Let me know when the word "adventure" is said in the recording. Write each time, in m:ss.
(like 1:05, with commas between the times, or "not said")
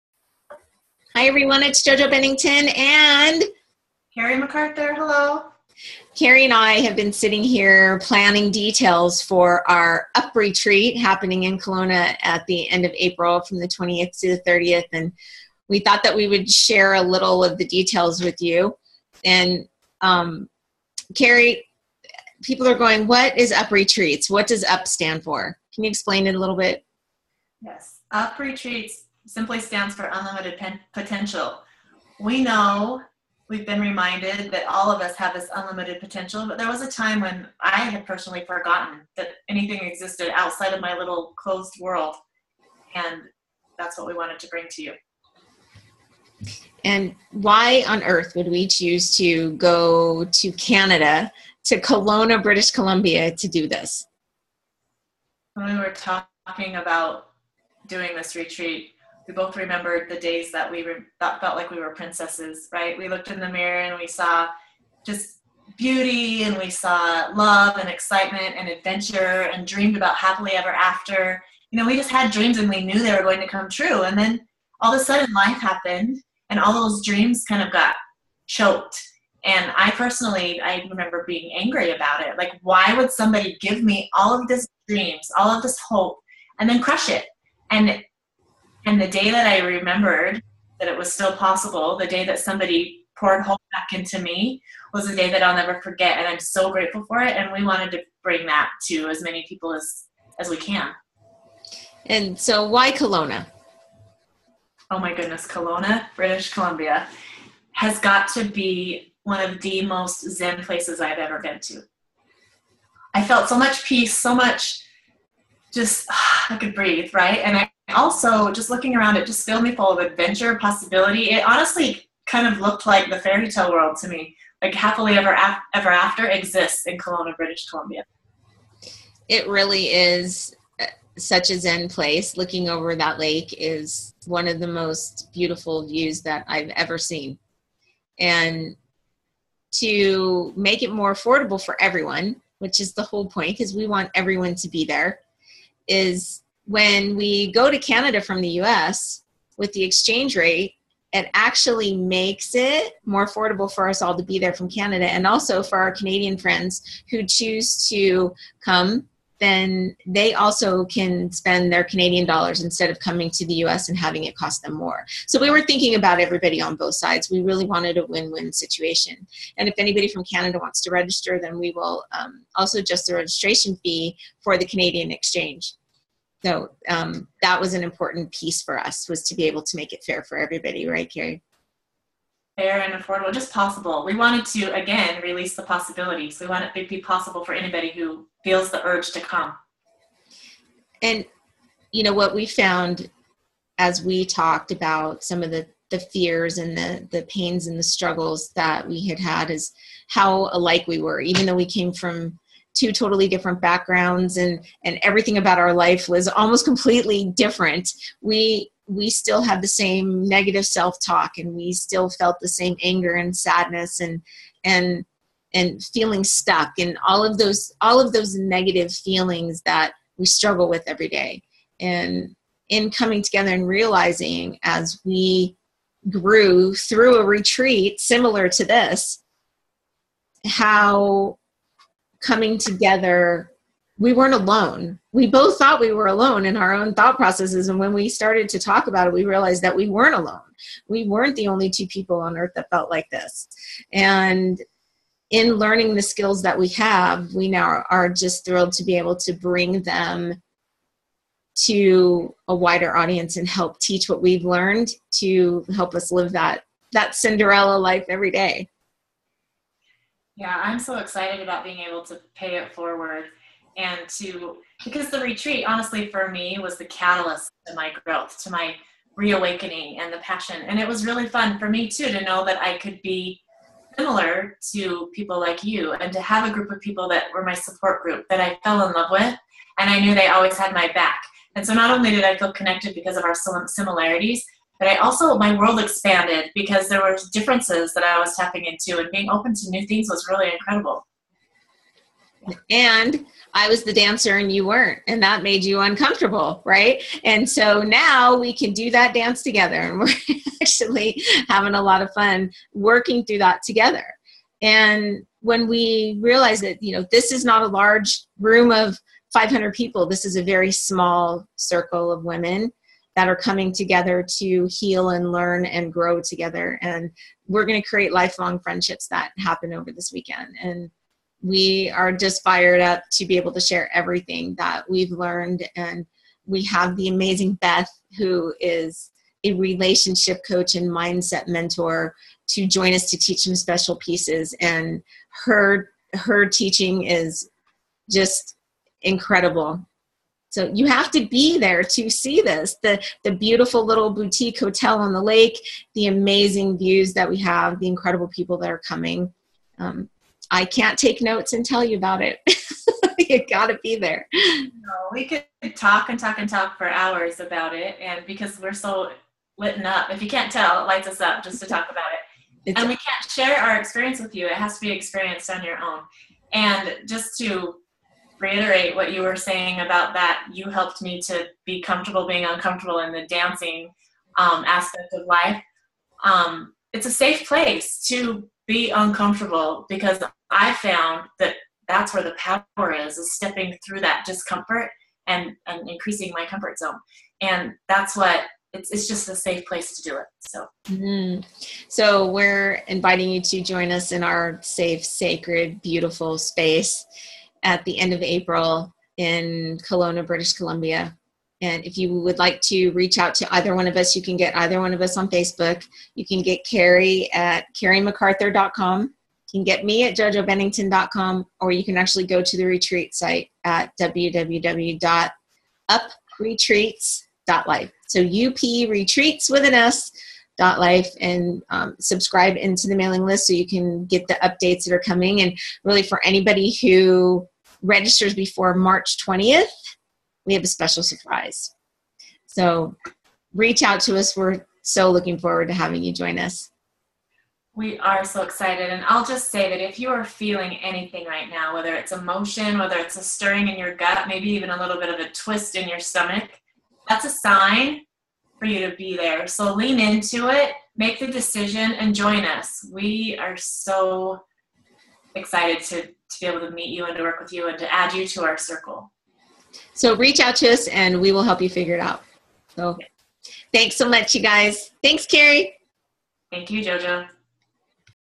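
1:08, 2:00.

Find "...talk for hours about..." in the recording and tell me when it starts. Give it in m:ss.
5:56.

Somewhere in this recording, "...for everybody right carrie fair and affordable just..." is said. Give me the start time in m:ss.
3:00.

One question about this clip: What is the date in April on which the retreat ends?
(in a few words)
30th.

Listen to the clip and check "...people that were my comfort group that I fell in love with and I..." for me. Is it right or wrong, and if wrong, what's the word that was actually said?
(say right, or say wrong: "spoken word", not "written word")
wrong: "support", not "comfort".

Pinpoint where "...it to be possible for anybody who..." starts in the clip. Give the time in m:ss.
3:06.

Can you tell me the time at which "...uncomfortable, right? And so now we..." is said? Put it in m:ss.
4:55.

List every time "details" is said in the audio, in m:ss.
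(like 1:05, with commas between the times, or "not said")
0:08, 0:17.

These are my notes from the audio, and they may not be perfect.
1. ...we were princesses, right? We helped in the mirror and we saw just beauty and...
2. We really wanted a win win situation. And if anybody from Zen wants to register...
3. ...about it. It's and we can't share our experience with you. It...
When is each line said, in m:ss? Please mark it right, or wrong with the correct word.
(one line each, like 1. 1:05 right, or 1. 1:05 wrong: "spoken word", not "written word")
1. 1:01 wrong: "looked", not "helped"
2. 2:47 wrong: "Canada", not "Zen"
3. 6:01 right.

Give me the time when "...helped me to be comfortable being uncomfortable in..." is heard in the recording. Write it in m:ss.
6:10.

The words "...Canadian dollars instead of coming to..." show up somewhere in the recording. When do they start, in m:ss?
2:41.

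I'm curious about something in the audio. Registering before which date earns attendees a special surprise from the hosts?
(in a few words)
March 20th.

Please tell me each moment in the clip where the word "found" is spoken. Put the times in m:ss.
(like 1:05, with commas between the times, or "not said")
3:12, 6:20.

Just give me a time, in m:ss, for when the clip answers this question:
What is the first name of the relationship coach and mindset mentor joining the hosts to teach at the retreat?
5:27.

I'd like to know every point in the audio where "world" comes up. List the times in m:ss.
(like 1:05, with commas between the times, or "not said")
0:41, 2:03, 4:45.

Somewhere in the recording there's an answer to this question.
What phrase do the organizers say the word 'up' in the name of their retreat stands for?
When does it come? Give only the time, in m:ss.
0:30.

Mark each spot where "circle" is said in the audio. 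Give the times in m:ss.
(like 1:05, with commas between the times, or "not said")
5:11, 7:38.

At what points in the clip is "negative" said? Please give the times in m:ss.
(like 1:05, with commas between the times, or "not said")
3:30, 3:38.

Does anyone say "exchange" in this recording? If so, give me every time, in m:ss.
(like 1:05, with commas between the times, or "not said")
2:29, 2:55.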